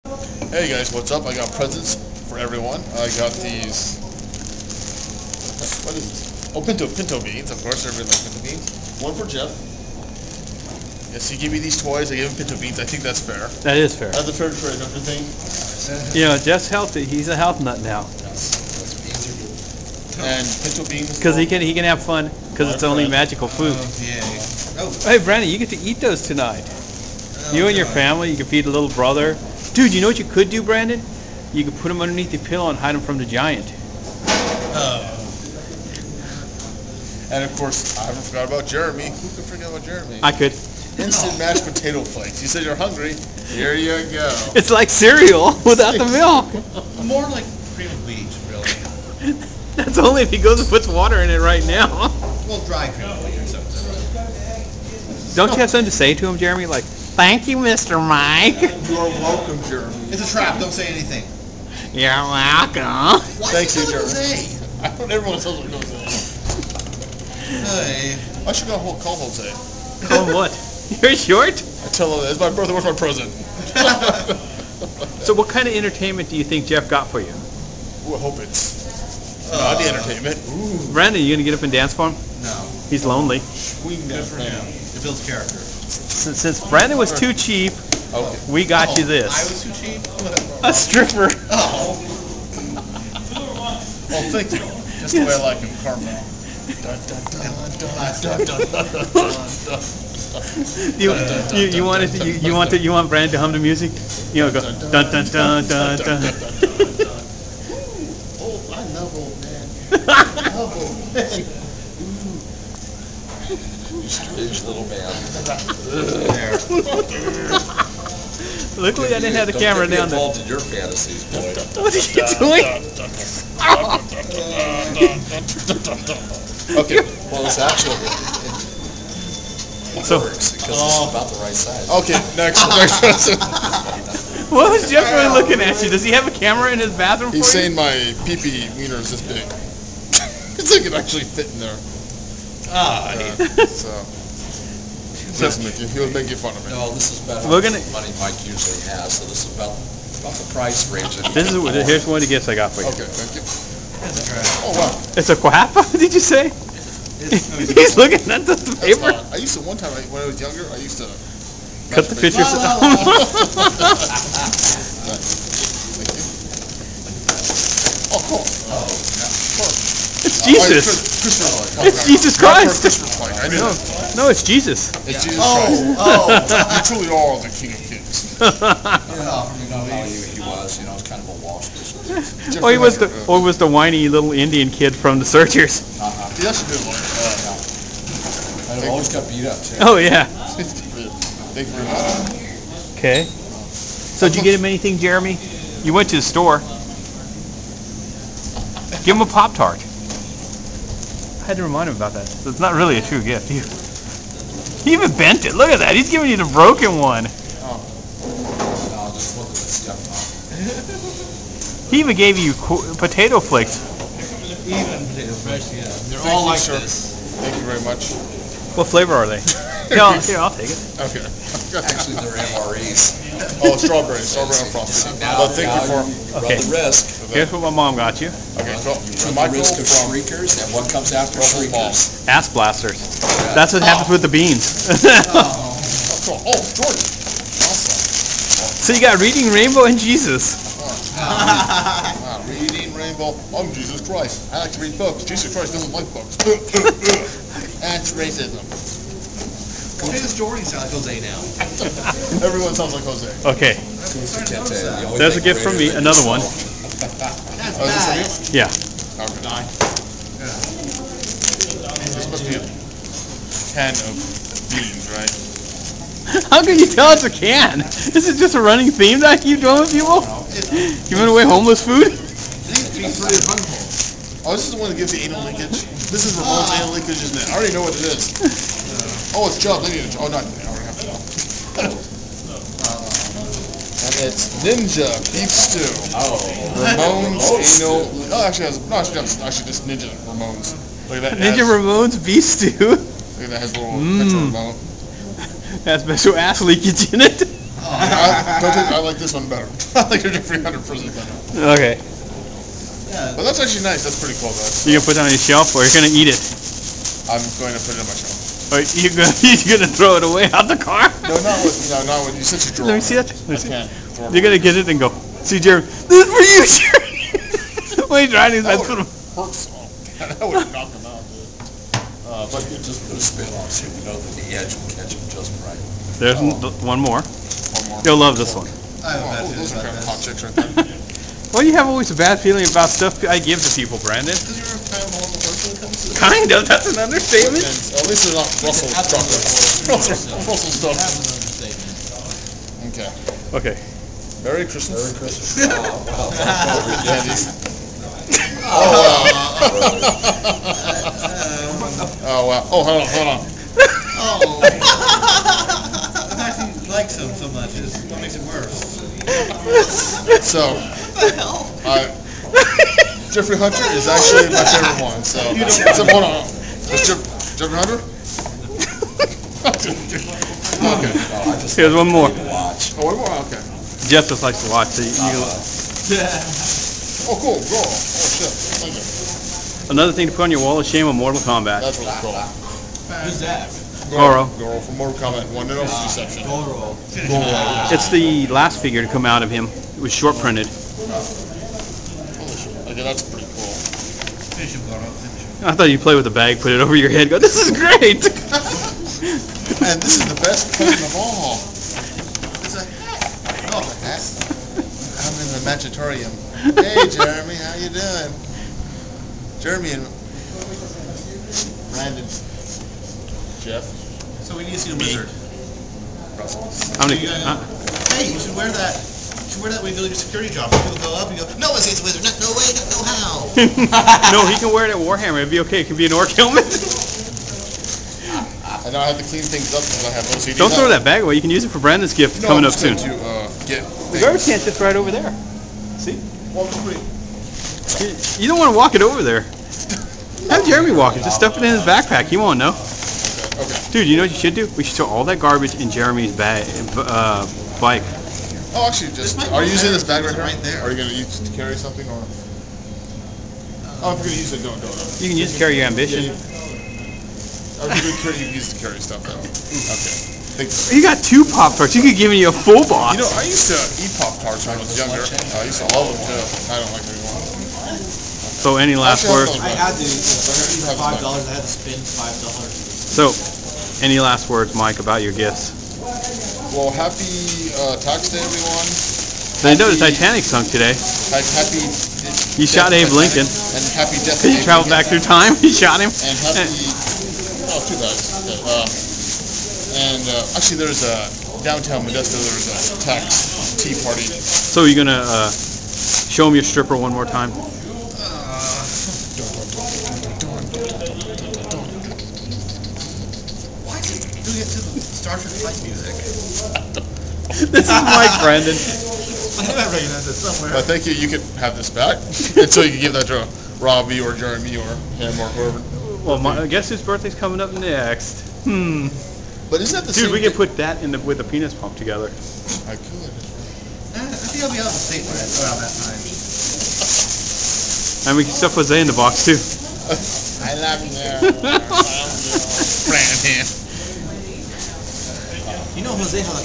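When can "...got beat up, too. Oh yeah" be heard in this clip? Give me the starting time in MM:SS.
03:09.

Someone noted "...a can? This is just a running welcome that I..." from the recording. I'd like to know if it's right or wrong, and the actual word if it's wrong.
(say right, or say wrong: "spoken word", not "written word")
wrong: "theme", not "welcome".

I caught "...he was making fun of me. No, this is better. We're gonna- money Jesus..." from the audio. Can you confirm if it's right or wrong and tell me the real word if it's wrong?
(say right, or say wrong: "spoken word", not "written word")
wrong: "Mike", not "Jesus".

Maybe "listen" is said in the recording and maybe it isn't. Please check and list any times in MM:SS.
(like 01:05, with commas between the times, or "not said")
02:25.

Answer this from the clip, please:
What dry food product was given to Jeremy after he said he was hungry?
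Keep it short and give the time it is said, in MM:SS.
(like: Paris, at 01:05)
Instant mashed potato flakes, at 00:40.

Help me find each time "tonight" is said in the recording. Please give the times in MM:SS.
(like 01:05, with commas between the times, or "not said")
00:26.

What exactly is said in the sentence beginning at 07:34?
Oh, if you're gonna use it, don't do not You can use it to carry your ambition.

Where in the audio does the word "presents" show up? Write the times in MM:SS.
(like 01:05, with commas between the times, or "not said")
00:01, 01:12.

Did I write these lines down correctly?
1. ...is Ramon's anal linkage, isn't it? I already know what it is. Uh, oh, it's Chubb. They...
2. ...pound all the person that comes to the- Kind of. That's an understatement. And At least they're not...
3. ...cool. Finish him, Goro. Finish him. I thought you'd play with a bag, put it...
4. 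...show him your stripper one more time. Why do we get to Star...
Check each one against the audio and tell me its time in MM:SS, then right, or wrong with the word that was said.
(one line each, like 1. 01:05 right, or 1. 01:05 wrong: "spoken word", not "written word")
1. 04:36 right
2. 05:34 right
3. 06:33 right
4. 08:15 right.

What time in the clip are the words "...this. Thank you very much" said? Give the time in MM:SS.
03:36.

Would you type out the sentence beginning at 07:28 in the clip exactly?
Oh, actually, just are you using this bag right, right there?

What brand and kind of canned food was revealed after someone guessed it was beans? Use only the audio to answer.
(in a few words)
Ninja Beef Stew.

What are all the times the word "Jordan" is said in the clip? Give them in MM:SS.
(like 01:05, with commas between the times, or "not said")
03:56, 04:10.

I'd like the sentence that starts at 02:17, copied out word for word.
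He's saying my pee pee wiener is this big.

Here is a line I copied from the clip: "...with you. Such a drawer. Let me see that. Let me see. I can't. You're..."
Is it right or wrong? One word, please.
right.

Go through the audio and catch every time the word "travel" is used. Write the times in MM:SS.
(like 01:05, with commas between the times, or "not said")
08:04.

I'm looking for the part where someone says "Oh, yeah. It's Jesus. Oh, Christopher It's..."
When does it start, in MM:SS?
02:48.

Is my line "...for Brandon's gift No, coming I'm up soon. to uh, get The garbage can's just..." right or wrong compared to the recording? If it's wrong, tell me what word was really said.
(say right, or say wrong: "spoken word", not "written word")
right.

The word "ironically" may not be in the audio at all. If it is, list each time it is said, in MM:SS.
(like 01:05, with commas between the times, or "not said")
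not said.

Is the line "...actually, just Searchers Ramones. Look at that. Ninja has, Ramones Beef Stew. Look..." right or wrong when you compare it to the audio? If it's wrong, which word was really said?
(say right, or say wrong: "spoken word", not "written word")
wrong: "Ninja", not "Searchers".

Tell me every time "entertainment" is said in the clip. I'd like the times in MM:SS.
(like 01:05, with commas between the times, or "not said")
01:15, 01:19.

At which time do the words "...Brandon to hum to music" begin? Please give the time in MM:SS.
01:43.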